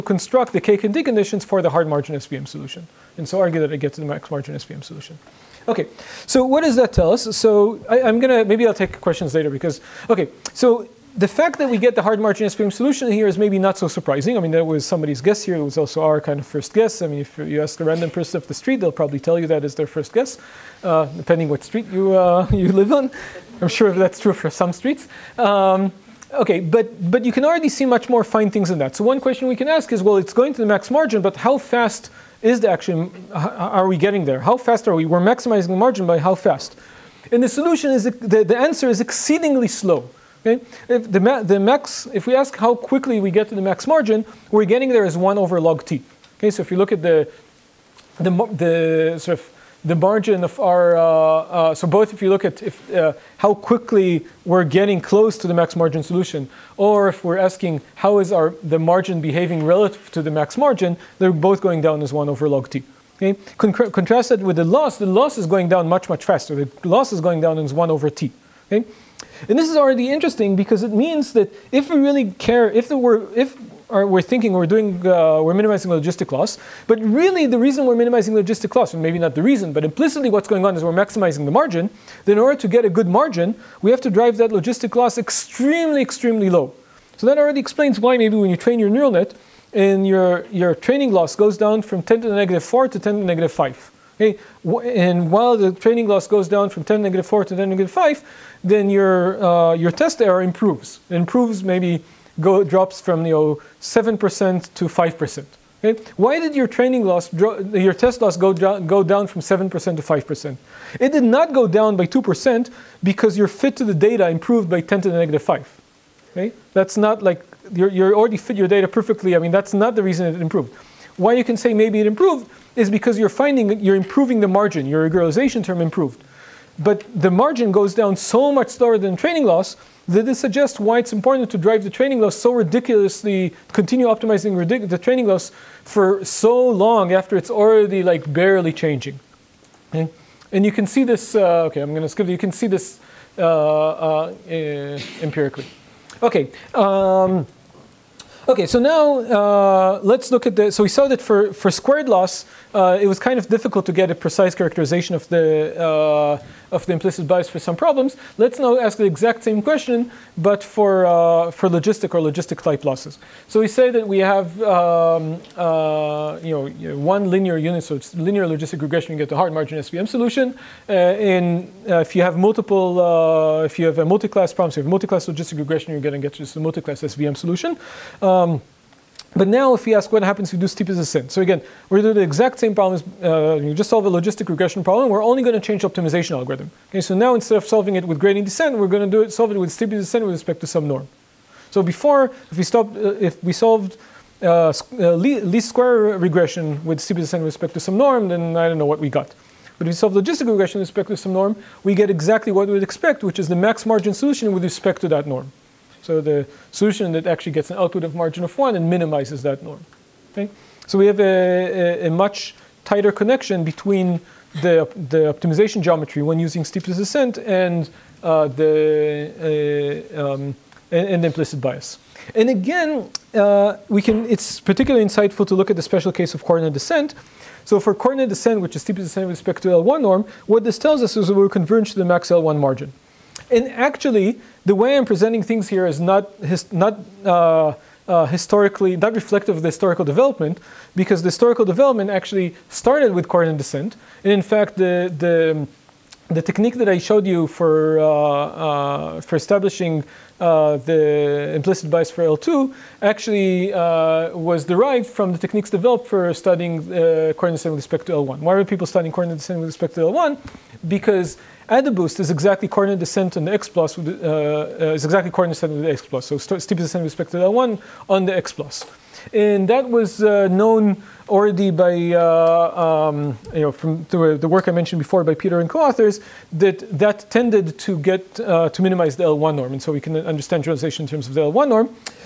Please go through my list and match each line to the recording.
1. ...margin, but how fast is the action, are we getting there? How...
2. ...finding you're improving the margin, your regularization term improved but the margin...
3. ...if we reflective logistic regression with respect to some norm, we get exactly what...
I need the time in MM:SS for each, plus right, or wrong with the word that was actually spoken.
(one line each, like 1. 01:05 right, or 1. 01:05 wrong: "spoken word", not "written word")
1. 00:30 right
2. 02:03 right
3. 03:19 wrong: "solve", not "reflective".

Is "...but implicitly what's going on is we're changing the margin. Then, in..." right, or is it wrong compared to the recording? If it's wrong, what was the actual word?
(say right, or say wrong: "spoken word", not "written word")
wrong: "maximizing", not "changing".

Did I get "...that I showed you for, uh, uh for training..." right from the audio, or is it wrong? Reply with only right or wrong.
wrong.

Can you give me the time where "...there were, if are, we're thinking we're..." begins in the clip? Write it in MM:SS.
01:12.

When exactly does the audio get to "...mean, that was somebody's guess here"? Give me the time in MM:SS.
00:14.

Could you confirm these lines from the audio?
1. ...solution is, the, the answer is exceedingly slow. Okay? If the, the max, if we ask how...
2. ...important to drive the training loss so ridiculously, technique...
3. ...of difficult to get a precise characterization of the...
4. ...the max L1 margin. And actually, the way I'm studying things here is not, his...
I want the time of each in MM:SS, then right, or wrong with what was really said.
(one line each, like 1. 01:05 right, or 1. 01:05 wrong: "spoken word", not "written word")
1. 00:37 right
2. 02:11 wrong: "continue", not "technique"
3. 02:33 right
4. 03:51 wrong: "presenting", not "studying".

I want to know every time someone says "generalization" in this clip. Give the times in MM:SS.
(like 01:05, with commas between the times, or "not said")
04:40.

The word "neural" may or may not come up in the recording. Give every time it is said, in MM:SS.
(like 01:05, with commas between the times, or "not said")
01:28.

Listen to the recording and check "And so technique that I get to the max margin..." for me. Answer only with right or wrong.
wrong.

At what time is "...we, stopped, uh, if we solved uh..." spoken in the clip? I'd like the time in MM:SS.
03:12.